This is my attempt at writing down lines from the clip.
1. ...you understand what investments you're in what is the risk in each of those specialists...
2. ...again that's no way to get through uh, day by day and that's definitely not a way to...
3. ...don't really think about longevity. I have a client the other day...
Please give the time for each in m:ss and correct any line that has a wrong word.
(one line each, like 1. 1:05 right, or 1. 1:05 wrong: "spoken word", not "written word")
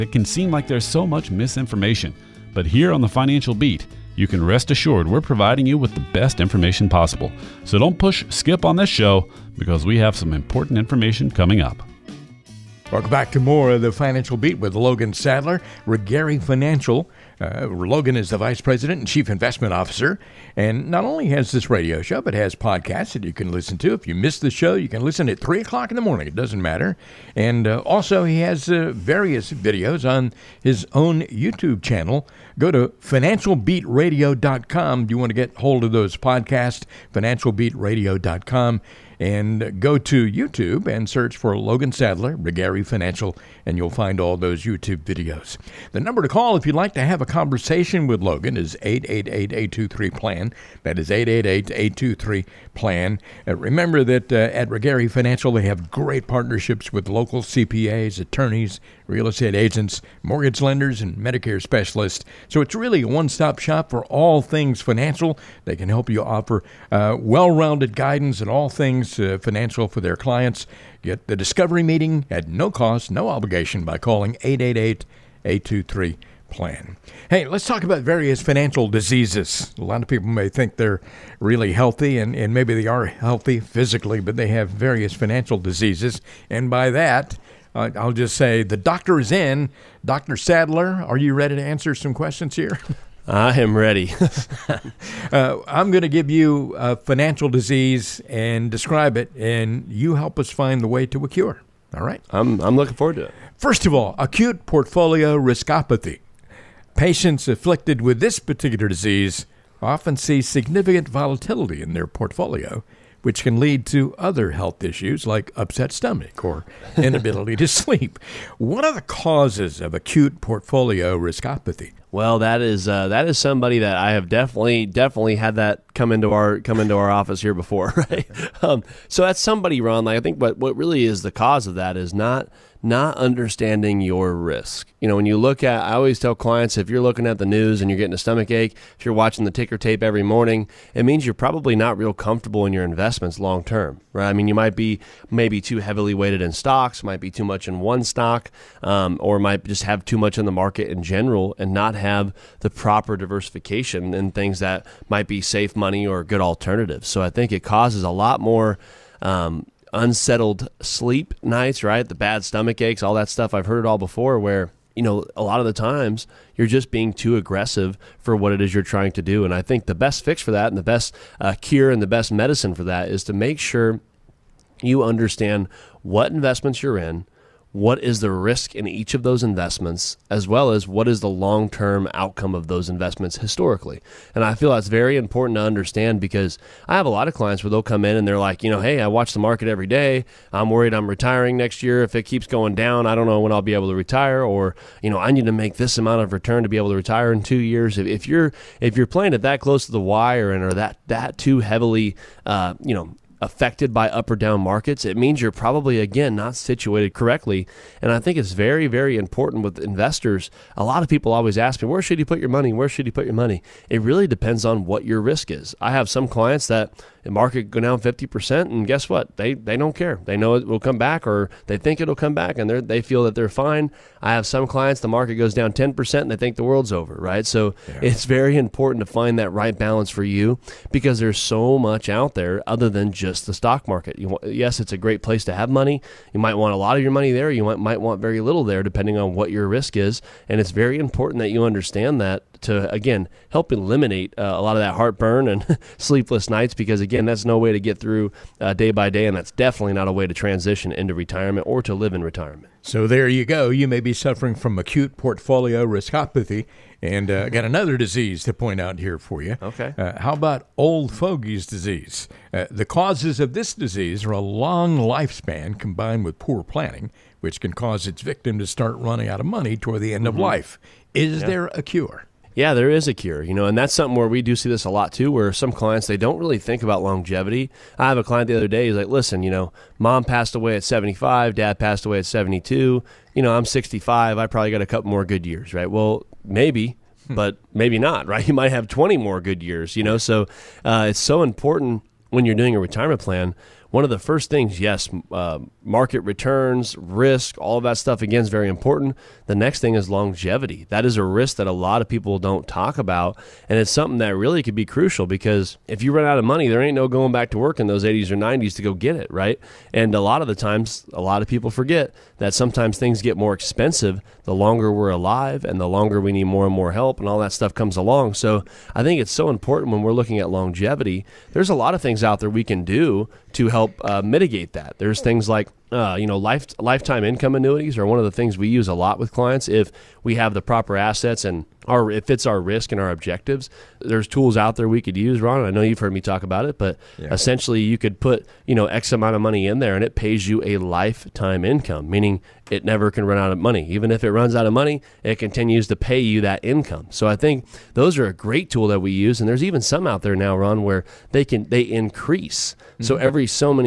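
1. 2:54 wrong: "investments", not "specialists"
2. 4:07 right
3. 4:36 right.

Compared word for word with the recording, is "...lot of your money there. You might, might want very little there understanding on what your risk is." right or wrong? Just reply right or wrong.
wrong.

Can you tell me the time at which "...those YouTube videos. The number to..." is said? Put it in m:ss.
0:44.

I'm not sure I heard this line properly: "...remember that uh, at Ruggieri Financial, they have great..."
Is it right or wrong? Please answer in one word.
right.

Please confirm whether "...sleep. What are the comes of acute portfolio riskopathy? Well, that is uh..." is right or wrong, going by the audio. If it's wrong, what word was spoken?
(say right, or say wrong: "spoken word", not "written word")
wrong: "causes", not "comes".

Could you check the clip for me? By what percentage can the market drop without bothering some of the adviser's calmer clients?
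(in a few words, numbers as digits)
50%.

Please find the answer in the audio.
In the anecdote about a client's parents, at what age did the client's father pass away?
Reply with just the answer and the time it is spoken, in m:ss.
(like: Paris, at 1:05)
72, at 4:42.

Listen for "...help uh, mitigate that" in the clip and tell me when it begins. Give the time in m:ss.
5:23.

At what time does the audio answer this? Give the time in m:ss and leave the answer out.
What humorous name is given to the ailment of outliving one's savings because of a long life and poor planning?
4:20.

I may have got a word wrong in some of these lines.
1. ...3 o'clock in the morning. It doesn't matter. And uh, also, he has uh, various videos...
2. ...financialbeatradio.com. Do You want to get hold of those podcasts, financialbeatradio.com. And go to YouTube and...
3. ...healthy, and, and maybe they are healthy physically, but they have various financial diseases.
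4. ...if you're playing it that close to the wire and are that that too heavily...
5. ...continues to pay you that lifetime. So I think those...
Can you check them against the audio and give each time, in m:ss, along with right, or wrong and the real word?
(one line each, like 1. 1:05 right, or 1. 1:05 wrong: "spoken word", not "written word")
1. 0:25 right
2. 0:33 right
3. 1:21 right
4. 3:18 right
5. 5:45 wrong: "income", not "lifetime".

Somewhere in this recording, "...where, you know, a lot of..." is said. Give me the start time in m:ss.
2:44.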